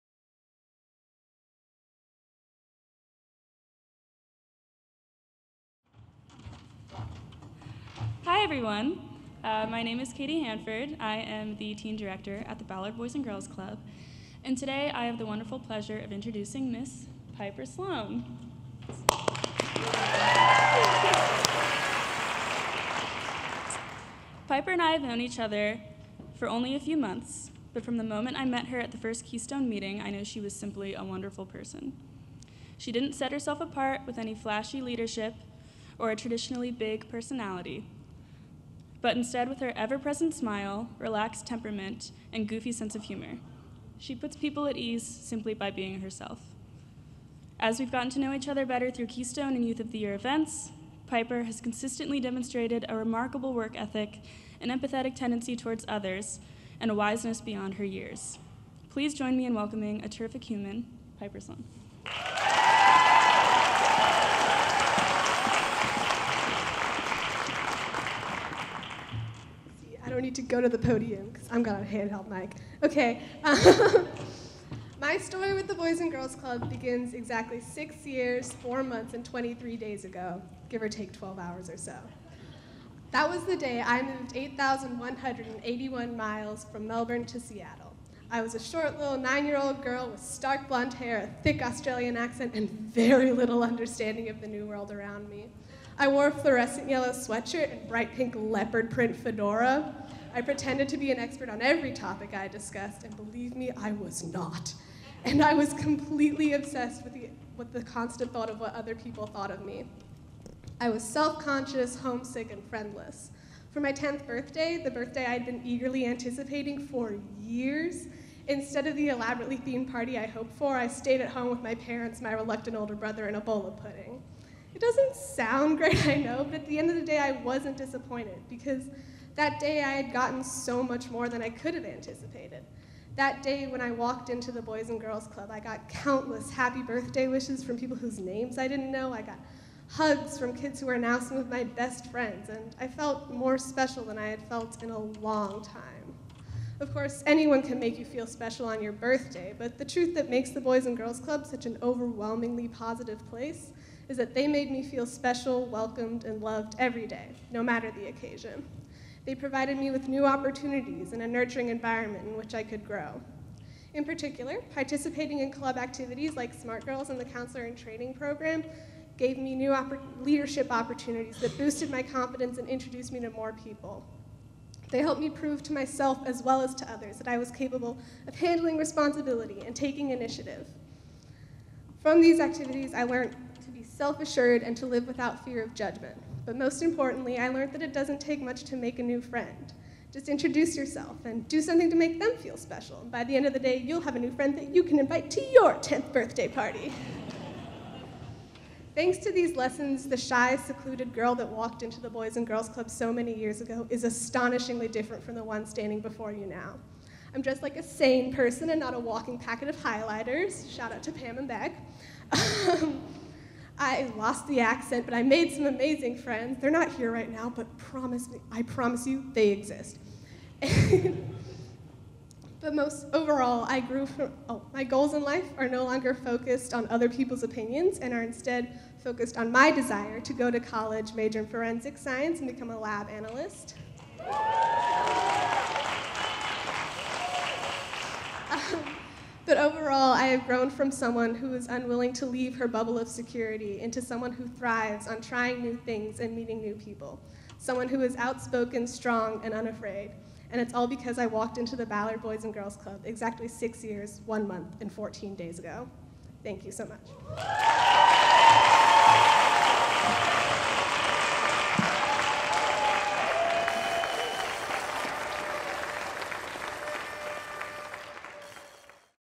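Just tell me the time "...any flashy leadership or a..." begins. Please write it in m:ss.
0:34.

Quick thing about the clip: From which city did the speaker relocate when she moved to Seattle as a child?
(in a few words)
Melbourne.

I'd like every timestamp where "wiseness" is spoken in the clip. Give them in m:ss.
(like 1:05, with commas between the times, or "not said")
0:56.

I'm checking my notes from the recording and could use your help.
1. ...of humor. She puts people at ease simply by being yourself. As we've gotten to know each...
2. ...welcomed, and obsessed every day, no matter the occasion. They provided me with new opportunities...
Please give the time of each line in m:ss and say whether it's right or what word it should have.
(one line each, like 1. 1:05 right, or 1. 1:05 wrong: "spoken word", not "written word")
1. 0:42 wrong: "herself", not "yourself"
2. 2:35 wrong: "loved", not "obsessed".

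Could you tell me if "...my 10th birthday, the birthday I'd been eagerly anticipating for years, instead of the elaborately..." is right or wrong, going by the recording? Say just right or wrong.
right.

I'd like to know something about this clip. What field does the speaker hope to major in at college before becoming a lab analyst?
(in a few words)
Forensic science.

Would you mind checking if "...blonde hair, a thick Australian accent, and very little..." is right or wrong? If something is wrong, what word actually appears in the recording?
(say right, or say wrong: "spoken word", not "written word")
right.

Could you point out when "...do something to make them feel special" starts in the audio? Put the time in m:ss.
3:11.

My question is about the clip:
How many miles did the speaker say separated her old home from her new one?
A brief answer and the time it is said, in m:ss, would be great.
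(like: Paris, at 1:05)
8,181, at 1:24.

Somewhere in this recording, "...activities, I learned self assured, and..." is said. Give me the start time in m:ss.
3:02.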